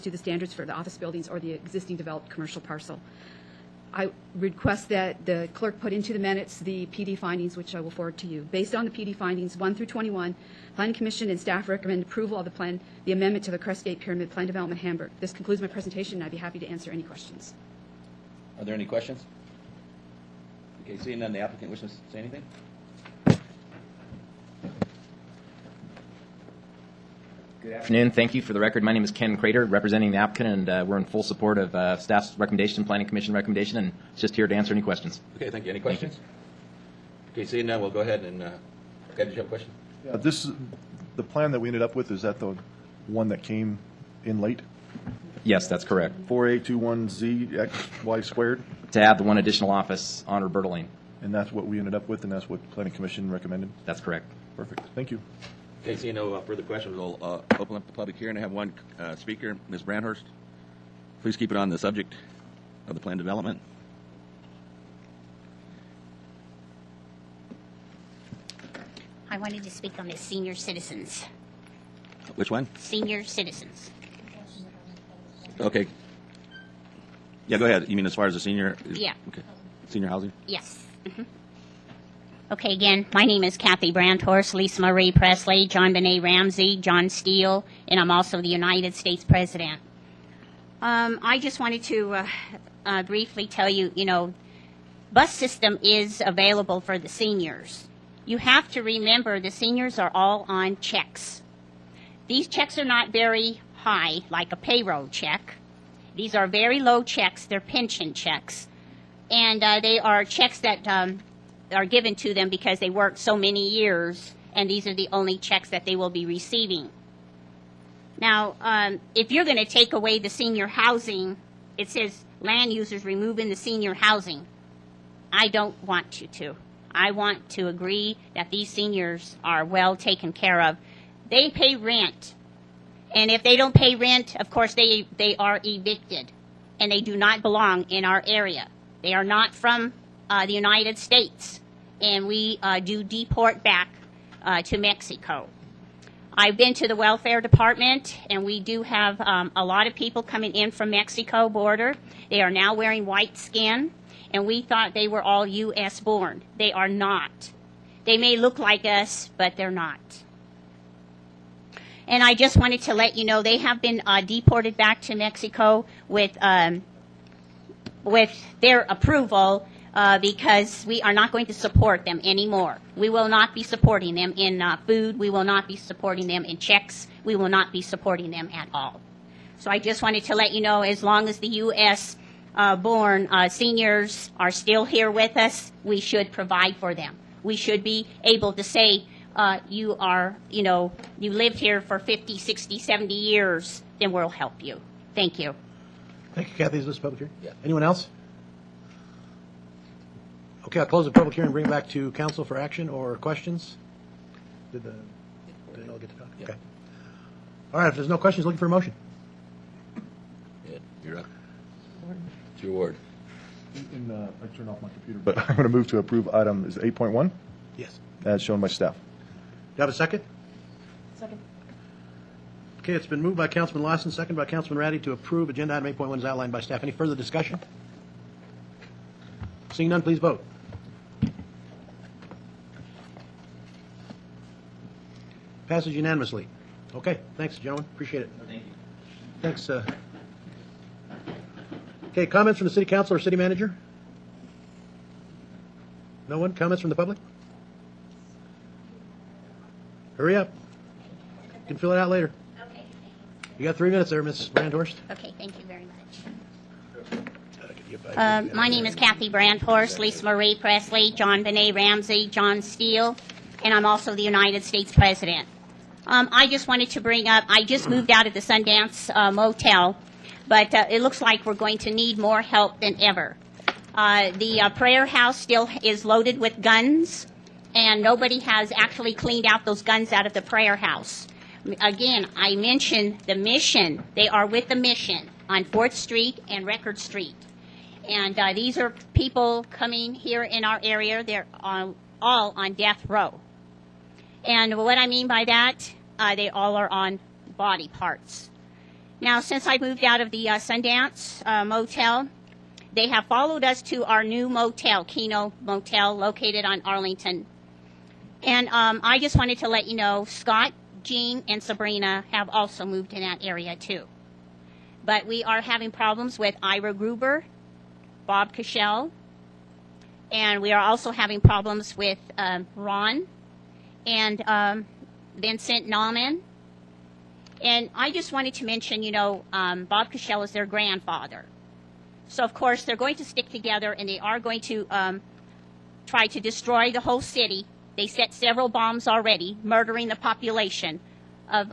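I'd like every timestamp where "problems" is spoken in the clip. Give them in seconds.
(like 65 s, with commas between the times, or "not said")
315 s, 321 s.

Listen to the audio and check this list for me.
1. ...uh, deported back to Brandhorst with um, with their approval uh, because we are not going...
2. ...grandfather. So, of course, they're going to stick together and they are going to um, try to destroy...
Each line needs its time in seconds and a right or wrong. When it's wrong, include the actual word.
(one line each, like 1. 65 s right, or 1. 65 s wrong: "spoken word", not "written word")
1. 164 s wrong: "Mexico", not "Brandhorst"
2. 330 s right.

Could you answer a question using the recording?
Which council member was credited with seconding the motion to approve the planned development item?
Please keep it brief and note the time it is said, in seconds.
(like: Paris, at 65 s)
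Councilman Ratti, at 224 s.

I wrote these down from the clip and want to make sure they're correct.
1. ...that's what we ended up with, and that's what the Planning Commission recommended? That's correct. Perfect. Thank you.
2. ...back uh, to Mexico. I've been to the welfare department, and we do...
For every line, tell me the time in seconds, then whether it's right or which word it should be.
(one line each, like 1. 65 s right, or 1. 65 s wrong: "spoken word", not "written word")
1. 51 s right
2. 143 s right.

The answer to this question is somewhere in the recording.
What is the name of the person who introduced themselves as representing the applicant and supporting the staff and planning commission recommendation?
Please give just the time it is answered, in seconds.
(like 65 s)
29 s.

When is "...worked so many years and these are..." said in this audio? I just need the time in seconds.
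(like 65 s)
112 s.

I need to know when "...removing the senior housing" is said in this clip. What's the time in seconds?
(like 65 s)
123 s.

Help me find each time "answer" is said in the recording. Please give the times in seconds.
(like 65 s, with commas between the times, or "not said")
16 s, 34 s.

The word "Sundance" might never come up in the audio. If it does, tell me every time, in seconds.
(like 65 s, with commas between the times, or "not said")
268 s, 300 s.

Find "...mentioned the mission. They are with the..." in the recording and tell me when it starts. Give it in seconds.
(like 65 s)
282 s.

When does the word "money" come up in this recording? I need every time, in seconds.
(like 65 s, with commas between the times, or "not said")
not said.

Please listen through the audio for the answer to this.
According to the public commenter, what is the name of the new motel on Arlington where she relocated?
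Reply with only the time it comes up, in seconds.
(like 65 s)
305 s.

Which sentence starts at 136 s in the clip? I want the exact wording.
And they do not belong in our area.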